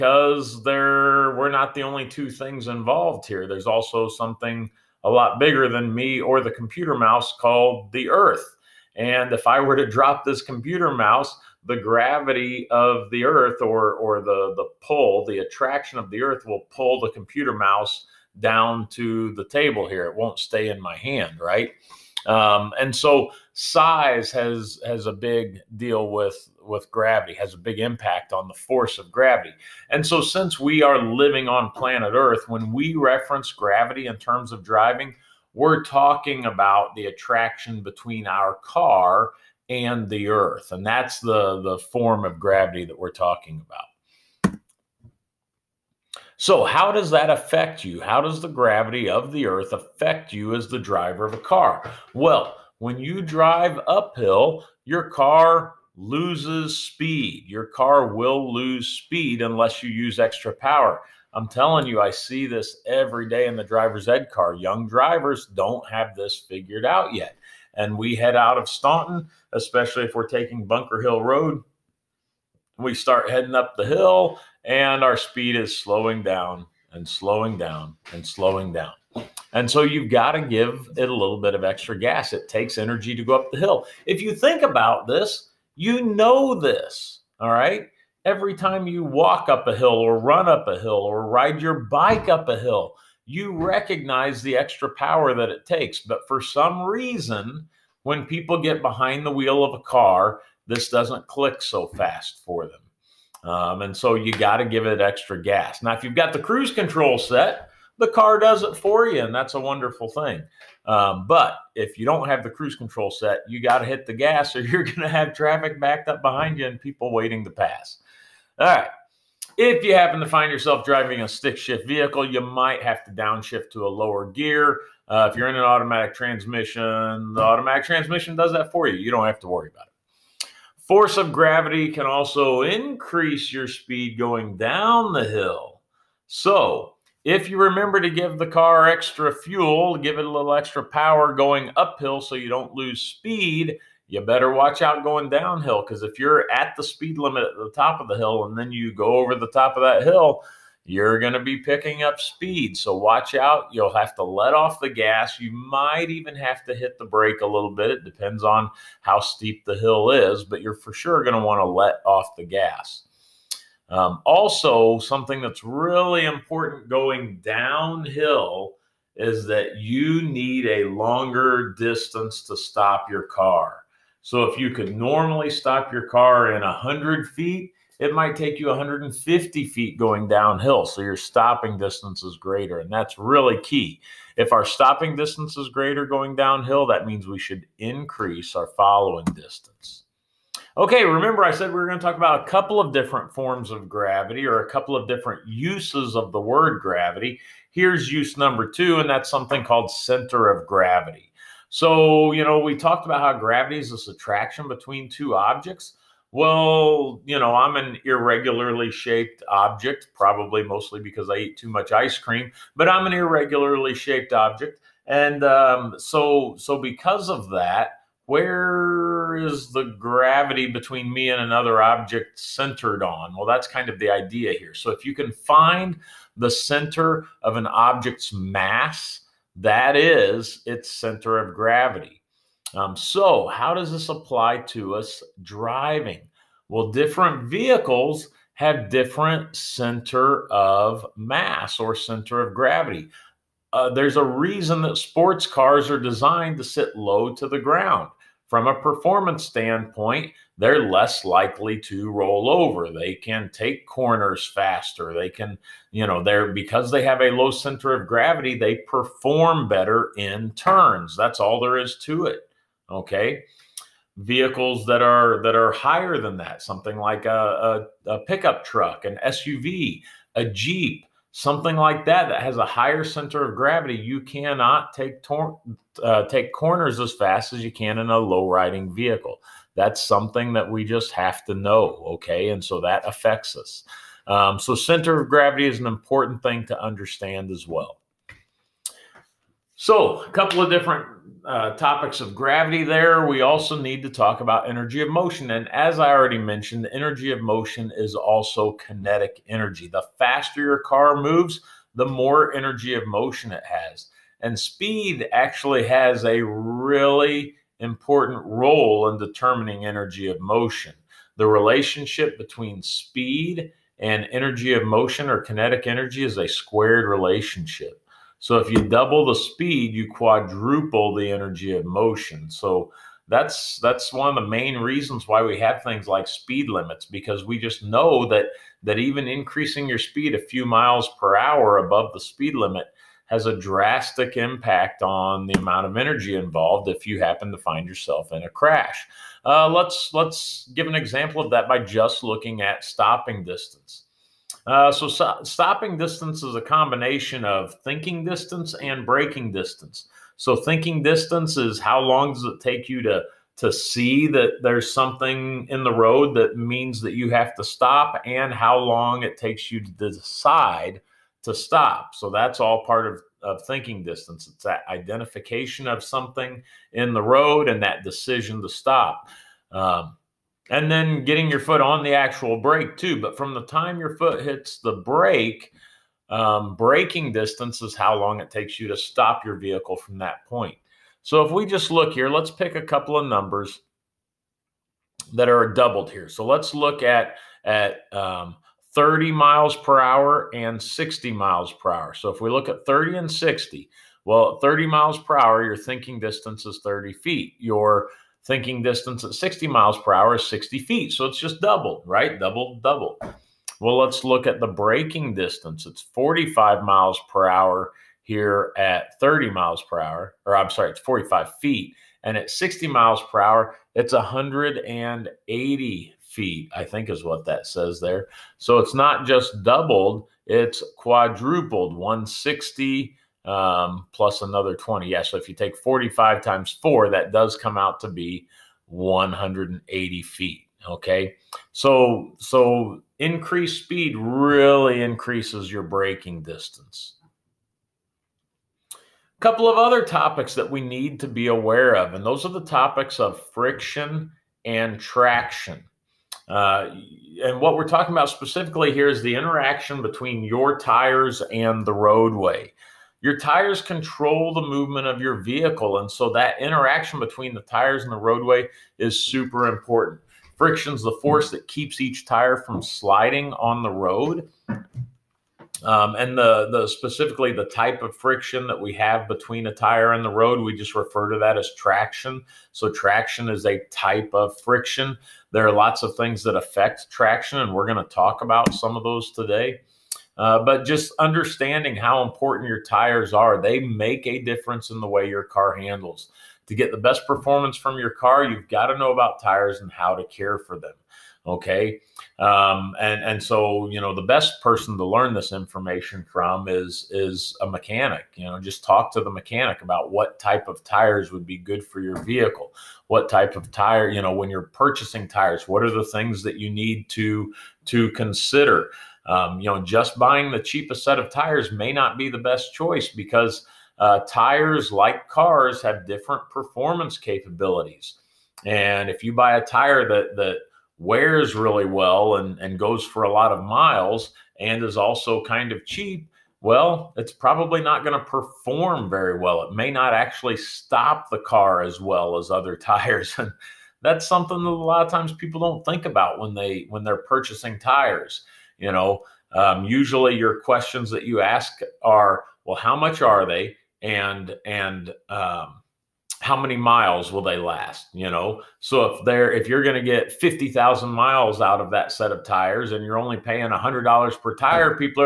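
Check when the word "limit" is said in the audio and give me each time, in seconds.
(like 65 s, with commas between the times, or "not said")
147 s, 326 s, 332 s.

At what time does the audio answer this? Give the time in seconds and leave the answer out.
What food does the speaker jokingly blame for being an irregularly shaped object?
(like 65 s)
211 s.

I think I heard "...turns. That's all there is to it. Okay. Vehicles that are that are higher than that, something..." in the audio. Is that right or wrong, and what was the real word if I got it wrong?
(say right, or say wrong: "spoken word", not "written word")
right.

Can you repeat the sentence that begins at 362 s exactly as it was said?
So that's all part of, of thinking distance.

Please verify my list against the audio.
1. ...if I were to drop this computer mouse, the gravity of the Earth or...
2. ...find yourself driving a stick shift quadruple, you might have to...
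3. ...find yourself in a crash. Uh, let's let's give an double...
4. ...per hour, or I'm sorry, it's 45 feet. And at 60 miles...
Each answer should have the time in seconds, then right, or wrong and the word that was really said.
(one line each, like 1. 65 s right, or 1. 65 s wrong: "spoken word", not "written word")
1. 9 s right
2. 120 s wrong: "vehicle", not "quadruple"
3. 337 s wrong: "example", not "double"
4. 409 s right.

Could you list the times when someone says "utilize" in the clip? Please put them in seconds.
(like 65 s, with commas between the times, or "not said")
not said.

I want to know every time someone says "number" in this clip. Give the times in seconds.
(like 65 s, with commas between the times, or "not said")
198 s, 383 s.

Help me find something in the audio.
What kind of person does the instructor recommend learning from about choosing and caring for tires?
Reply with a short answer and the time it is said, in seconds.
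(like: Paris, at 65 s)
a mechanic, at 497 s.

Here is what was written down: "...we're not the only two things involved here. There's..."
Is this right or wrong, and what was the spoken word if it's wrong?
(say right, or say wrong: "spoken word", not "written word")
right.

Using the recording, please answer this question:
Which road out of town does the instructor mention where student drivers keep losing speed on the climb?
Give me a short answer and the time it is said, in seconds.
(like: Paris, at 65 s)
Bunker Hill Road, at 70 s.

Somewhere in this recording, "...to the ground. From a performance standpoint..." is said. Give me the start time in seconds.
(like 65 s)
247 s.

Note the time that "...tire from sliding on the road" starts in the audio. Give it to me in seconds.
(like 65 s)
462 s.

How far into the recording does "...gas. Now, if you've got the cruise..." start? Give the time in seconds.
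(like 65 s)
105 s.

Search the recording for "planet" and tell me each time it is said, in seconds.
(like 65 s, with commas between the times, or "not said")
31 s.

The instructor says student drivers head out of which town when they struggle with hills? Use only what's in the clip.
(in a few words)
Staunton.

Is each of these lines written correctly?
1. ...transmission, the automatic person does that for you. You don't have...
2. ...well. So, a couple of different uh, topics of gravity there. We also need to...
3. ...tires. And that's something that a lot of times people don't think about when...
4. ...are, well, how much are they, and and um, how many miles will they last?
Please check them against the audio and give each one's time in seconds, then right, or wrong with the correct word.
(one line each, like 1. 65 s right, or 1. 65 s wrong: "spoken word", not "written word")
1. 126 s wrong: "transmission", not "person"
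2. 287 s right
3. 532 s right
4. 542 s right.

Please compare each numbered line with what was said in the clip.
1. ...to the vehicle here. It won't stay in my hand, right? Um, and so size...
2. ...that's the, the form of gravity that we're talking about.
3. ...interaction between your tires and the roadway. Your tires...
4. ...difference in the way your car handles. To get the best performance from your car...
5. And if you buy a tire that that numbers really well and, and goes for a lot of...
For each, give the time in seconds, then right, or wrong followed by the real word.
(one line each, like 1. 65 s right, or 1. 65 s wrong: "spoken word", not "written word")
1. 18 s wrong: "table", not "vehicle"
2. 40 s right
3. 449 s right
4. 484 s right
5. 518 s wrong: "wears", not "numbers".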